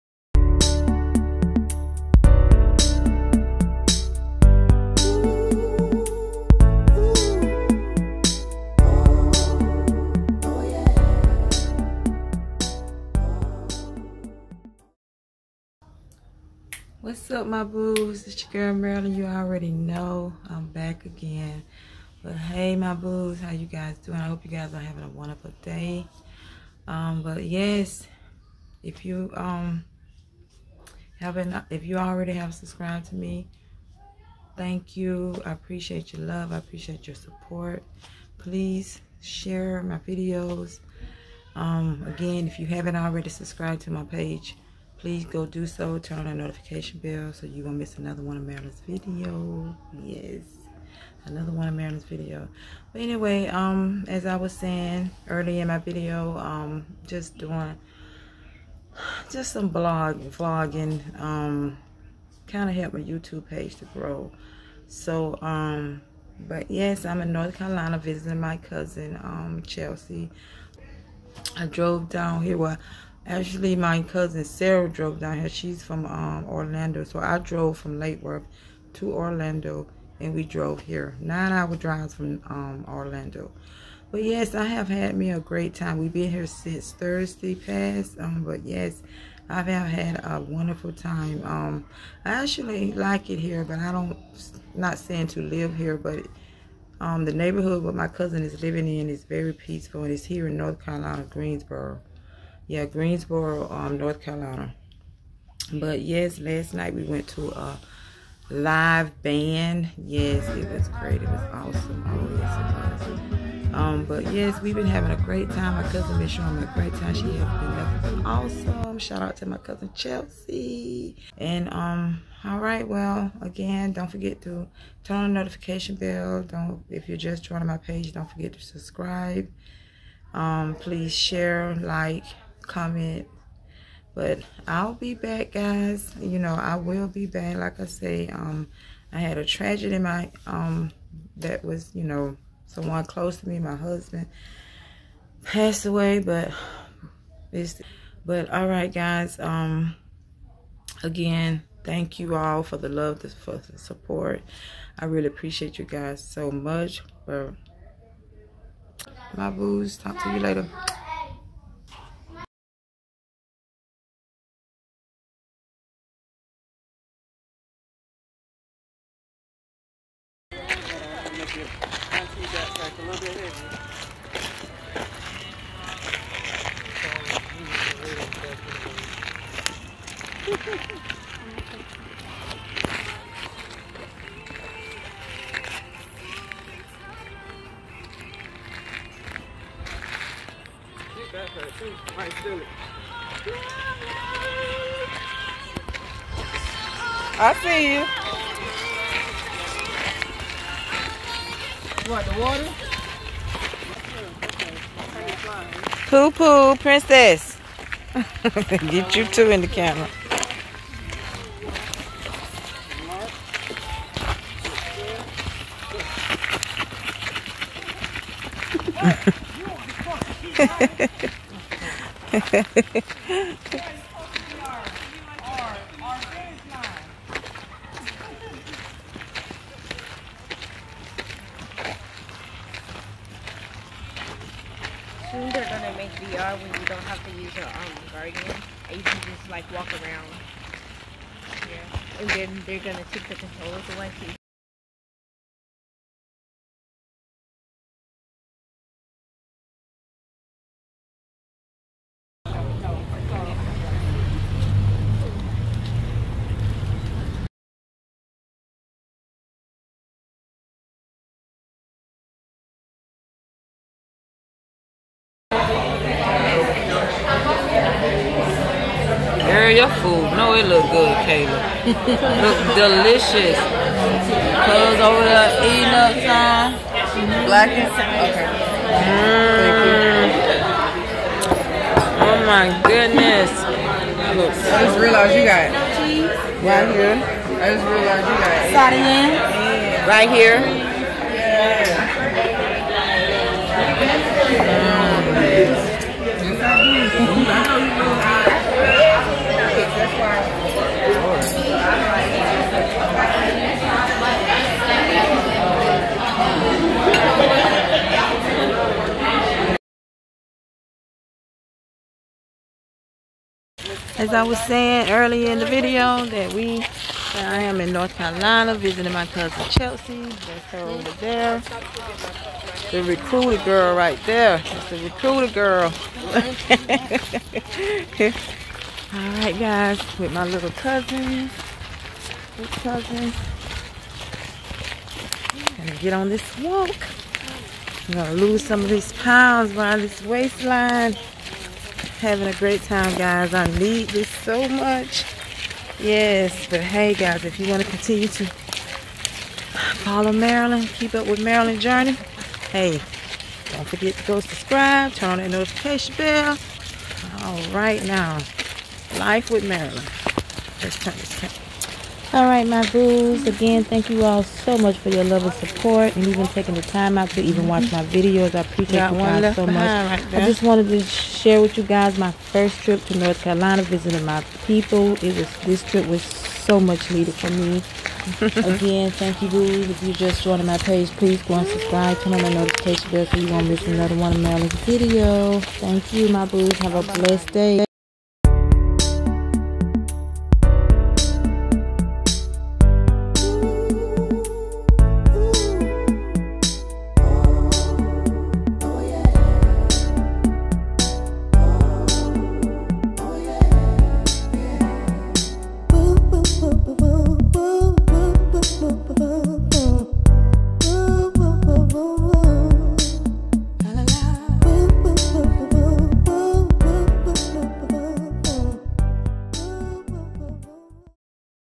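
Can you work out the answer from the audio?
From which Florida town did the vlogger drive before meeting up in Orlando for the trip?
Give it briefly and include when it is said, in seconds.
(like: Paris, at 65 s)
Lake Worth, at 77 s.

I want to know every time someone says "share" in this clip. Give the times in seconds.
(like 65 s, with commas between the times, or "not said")
39 s, 131 s, 371 s.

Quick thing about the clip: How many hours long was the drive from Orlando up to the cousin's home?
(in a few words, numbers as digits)
9.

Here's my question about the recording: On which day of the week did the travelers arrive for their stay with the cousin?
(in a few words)
Thursday.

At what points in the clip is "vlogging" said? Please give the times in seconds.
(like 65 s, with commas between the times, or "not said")
60 s.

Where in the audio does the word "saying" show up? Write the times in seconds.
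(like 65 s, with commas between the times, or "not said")
54 s, 94 s, 314 s.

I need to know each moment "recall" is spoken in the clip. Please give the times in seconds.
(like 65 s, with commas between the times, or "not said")
not said.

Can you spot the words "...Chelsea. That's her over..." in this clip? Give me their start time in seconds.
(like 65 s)
319 s.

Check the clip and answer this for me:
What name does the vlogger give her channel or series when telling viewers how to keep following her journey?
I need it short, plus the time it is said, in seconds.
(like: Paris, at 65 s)
Life with Marilyn, at 359 s.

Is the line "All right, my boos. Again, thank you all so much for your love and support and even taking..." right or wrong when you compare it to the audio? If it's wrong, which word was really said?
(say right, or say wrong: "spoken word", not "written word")
right.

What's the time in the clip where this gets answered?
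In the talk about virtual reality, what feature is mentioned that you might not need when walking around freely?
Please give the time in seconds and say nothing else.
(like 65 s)
238 s.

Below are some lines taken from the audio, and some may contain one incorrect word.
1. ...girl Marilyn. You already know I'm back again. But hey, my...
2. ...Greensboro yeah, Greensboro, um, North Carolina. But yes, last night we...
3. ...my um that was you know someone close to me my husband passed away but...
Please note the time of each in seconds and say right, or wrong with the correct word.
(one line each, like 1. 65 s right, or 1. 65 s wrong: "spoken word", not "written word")
1. 18 s right
2. 101 s right
3. 140 s right.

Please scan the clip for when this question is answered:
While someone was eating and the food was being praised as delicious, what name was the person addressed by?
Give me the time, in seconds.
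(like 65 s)
271 s.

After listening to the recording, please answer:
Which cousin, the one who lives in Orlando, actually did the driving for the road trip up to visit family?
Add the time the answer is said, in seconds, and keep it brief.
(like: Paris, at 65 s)
Sarah, at 74 s.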